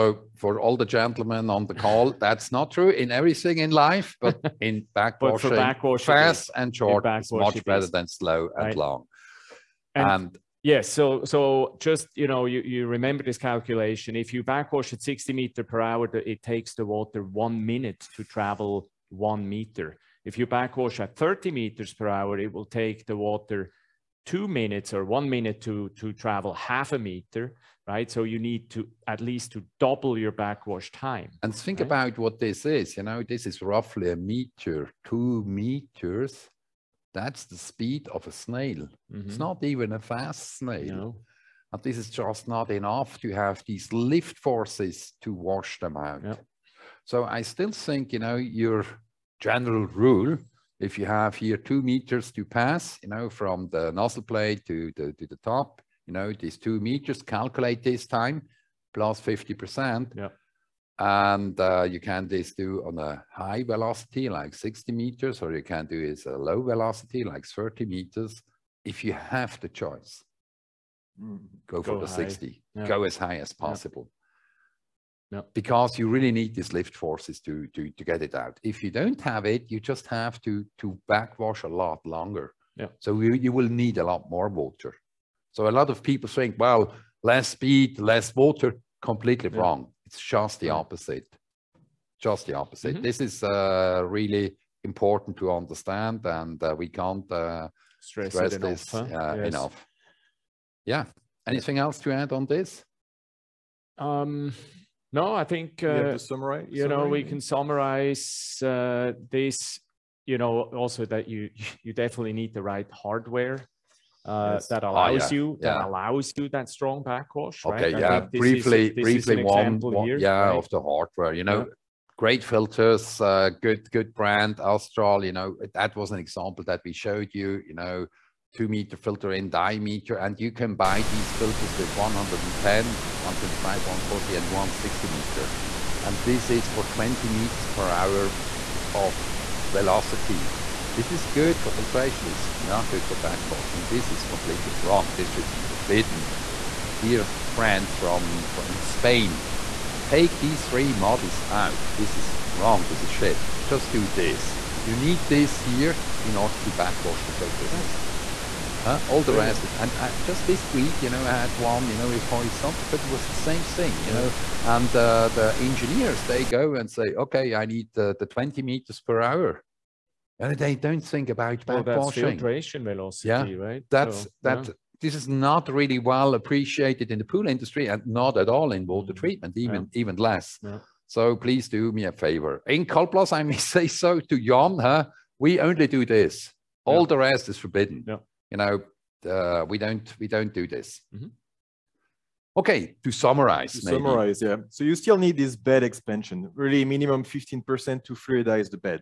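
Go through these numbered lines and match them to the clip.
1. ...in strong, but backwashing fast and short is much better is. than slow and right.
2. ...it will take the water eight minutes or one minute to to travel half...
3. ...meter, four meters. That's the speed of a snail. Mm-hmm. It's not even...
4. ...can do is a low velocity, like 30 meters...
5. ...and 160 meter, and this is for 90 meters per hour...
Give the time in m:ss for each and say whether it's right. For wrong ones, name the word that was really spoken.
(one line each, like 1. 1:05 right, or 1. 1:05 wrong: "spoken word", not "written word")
1. 0:04 wrong: "backwashing", not "strong"
2. 0:22 wrong: "two", not "eight"
3. 0:34 wrong: "two", not "four"
4. 1:05 right
5. 2:14 wrong: "20", not "90".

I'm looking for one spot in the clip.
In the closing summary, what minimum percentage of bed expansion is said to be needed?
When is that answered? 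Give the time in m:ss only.
3:17.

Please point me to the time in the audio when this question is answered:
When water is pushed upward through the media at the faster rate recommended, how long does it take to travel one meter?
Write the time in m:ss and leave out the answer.
0:17.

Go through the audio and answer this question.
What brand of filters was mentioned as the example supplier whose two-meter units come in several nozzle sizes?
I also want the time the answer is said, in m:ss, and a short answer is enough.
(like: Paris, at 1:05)
Astral, at 2:04.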